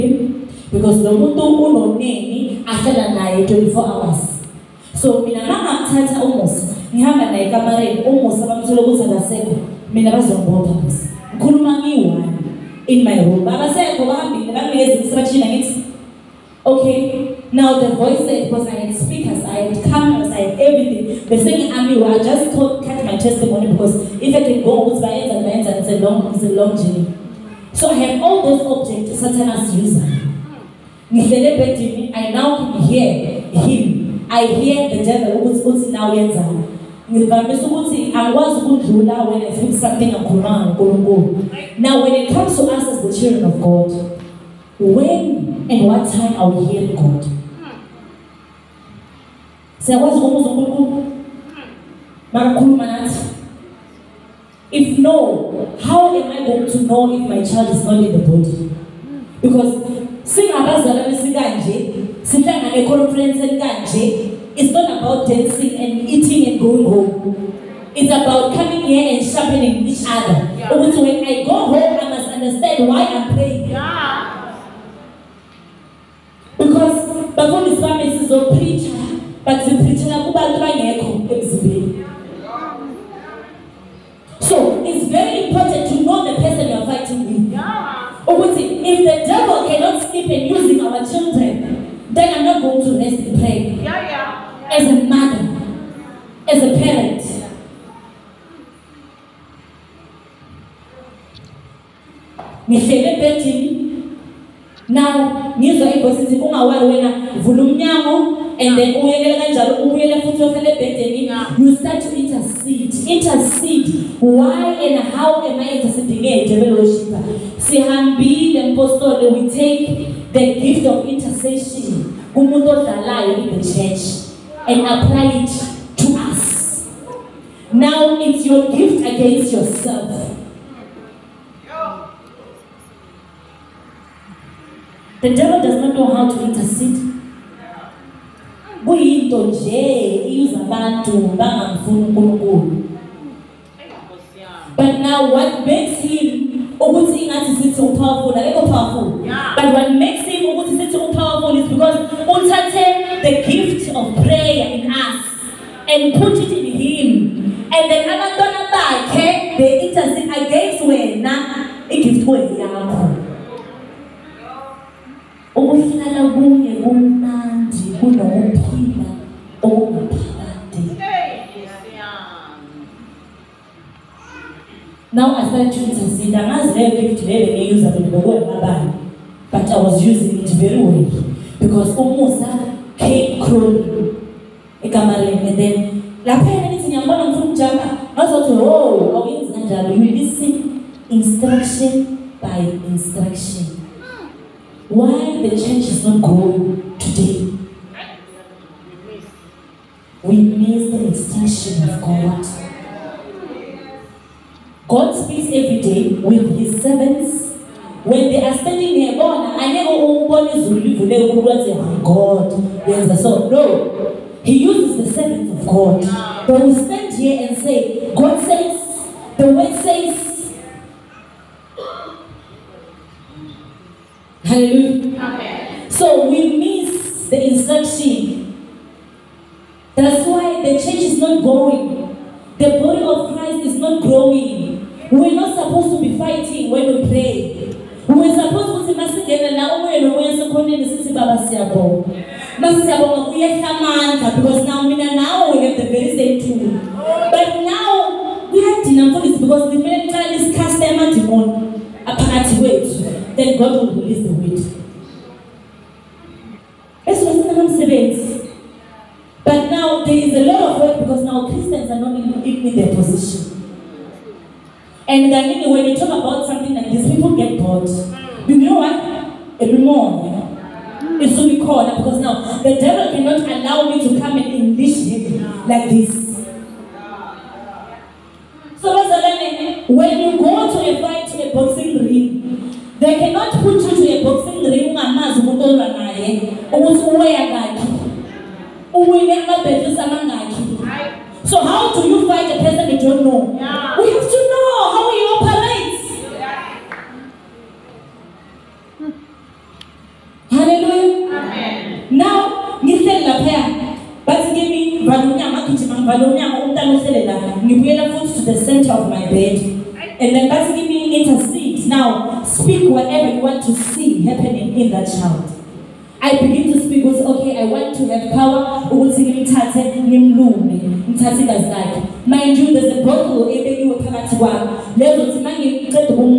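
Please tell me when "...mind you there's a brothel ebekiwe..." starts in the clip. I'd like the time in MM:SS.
05:22.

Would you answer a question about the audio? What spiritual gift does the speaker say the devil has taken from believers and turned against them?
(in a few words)
intercession.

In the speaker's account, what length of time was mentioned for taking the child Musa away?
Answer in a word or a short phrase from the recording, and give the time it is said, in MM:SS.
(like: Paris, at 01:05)
24 hours, at 00:03.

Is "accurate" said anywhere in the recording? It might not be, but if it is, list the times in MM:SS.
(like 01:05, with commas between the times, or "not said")
not said.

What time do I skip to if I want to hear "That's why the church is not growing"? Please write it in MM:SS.
03:49.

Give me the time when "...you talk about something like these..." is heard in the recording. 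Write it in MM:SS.
04:25.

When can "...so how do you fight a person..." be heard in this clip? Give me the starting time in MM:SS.
04:51.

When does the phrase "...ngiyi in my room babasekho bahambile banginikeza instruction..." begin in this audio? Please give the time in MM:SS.
00:11.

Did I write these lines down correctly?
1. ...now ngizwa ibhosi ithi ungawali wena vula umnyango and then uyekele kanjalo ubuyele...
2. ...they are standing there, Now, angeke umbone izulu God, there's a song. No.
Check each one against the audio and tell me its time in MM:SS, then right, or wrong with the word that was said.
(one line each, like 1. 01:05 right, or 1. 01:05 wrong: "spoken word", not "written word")
1. 01:44 right
2. 03:28 wrong: "God", not "Now".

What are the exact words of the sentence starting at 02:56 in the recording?
And as they but I was using it very well because Umusa came crawling.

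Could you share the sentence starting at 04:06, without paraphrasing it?
But now we kuyadina this because the kumele niqale isikhasta emadimoni aphakathi weight.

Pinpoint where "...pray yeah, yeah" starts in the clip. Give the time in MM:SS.
01:33.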